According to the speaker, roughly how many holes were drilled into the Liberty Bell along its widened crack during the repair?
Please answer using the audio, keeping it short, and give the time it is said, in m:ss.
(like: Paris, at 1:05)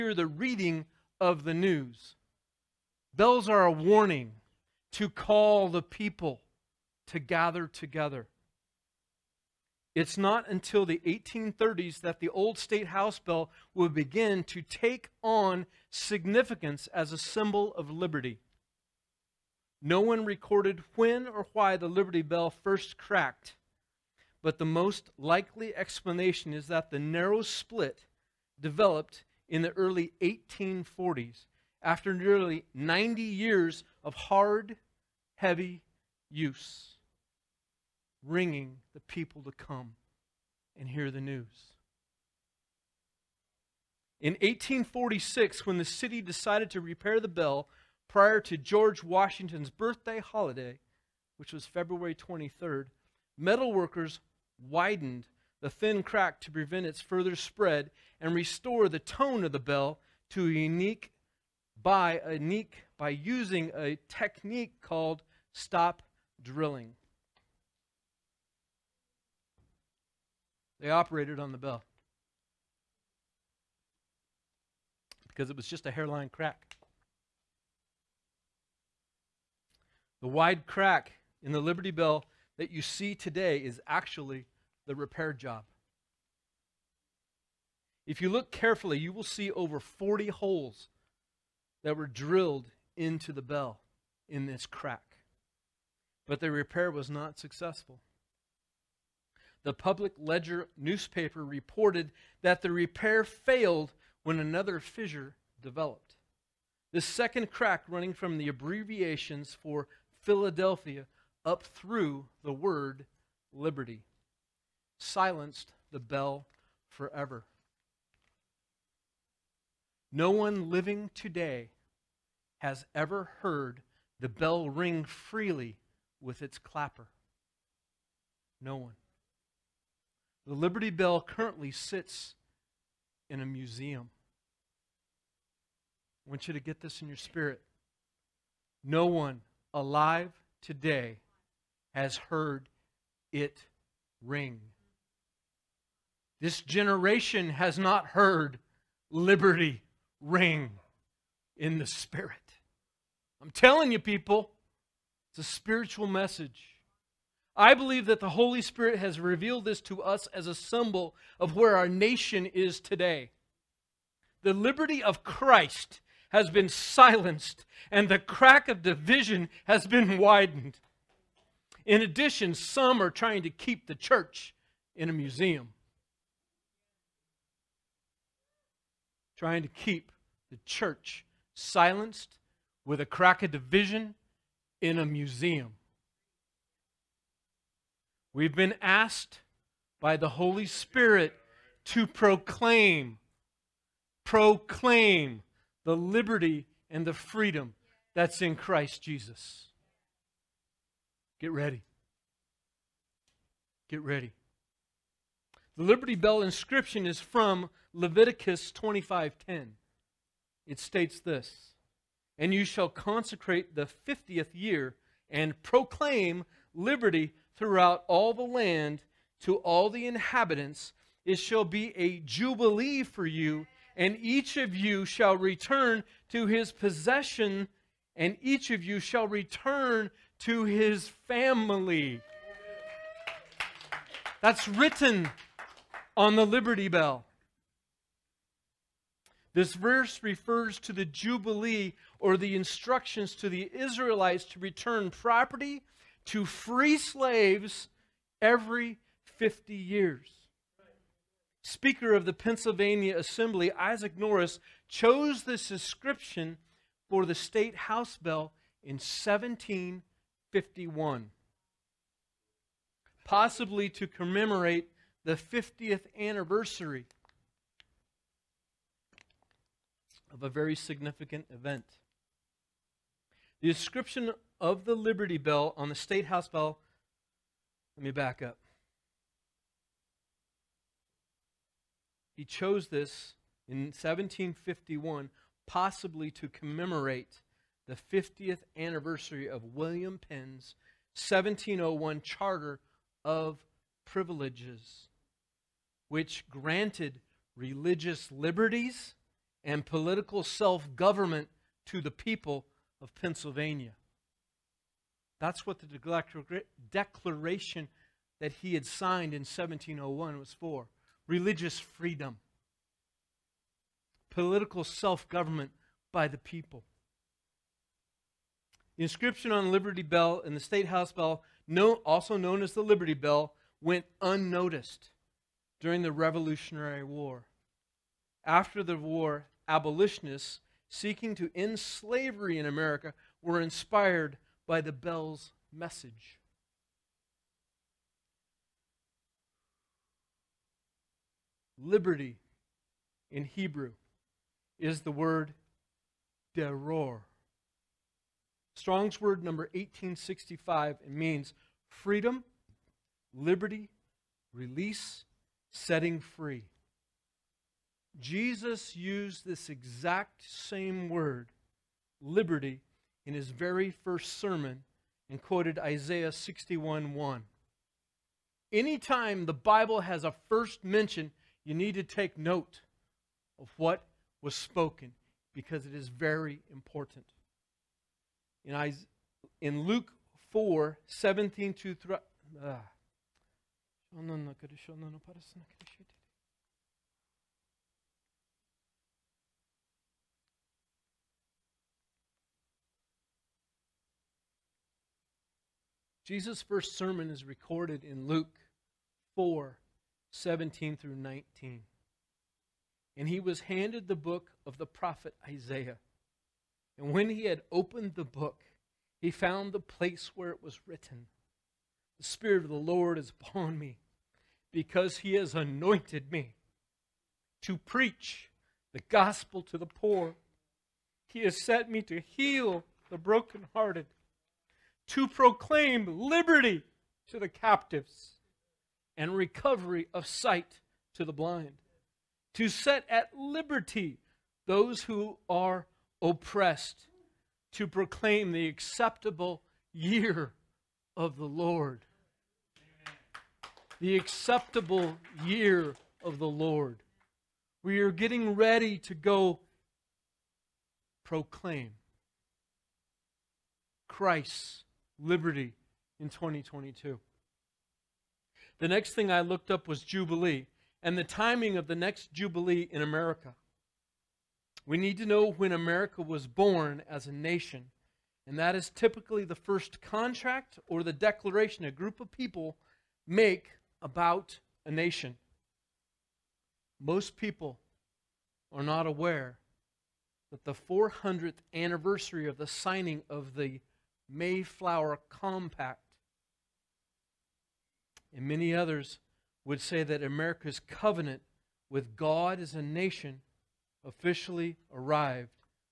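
over 40, at 1:29.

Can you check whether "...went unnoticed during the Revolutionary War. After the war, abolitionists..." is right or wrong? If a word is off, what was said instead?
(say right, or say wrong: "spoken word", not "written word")
right.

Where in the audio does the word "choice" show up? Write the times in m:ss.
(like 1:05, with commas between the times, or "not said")
not said.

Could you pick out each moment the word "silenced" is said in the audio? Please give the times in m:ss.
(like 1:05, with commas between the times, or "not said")
1:54, 2:46, 3:01.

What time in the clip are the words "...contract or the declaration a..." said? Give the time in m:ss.
7:50.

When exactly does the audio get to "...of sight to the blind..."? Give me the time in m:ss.
7:10.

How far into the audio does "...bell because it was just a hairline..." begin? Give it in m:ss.
1:11.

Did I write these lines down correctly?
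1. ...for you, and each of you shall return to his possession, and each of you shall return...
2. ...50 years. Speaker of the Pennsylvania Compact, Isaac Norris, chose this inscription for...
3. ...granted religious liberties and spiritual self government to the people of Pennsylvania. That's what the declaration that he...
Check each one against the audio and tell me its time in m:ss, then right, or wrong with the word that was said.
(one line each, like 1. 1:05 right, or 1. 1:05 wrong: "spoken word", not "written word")
1. 3:43 right
2. 4:09 wrong: "Assembly", not "Compact"
3. 4:56 wrong: "political", not "spiritual".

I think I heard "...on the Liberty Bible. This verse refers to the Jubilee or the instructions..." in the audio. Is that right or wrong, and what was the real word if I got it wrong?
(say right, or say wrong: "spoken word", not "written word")
wrong: "Bell", not "Bible".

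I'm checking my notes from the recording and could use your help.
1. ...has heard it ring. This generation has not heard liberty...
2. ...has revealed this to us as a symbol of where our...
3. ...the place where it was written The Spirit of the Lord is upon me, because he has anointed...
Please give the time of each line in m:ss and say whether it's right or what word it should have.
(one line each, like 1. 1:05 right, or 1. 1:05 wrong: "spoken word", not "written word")
1. 2:21 right
2. 2:39 right
3. 6:49 right.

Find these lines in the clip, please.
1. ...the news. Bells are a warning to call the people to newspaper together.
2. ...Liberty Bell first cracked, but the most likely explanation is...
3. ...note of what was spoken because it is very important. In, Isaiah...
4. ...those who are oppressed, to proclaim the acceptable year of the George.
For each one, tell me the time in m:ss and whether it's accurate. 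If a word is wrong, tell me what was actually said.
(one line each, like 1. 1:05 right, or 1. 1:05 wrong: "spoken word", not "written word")
1. 0:01 wrong: "gather", not "newspaper"
2. 0:21 right
3. 6:12 right
4. 7:14 wrong: "Lord", not "George".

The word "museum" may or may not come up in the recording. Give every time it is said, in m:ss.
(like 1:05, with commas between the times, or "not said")
2:13, 2:55, 3:05.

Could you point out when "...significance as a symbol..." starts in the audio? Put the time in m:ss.
0:15.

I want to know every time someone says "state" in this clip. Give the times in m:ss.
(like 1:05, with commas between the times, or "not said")
0:12, 3:30, 4:17, 4:35, 5:20.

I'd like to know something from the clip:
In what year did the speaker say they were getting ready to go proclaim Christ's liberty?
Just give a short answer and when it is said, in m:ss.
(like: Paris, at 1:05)
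2022, at 7:36.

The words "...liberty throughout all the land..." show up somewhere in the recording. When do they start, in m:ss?
3:36.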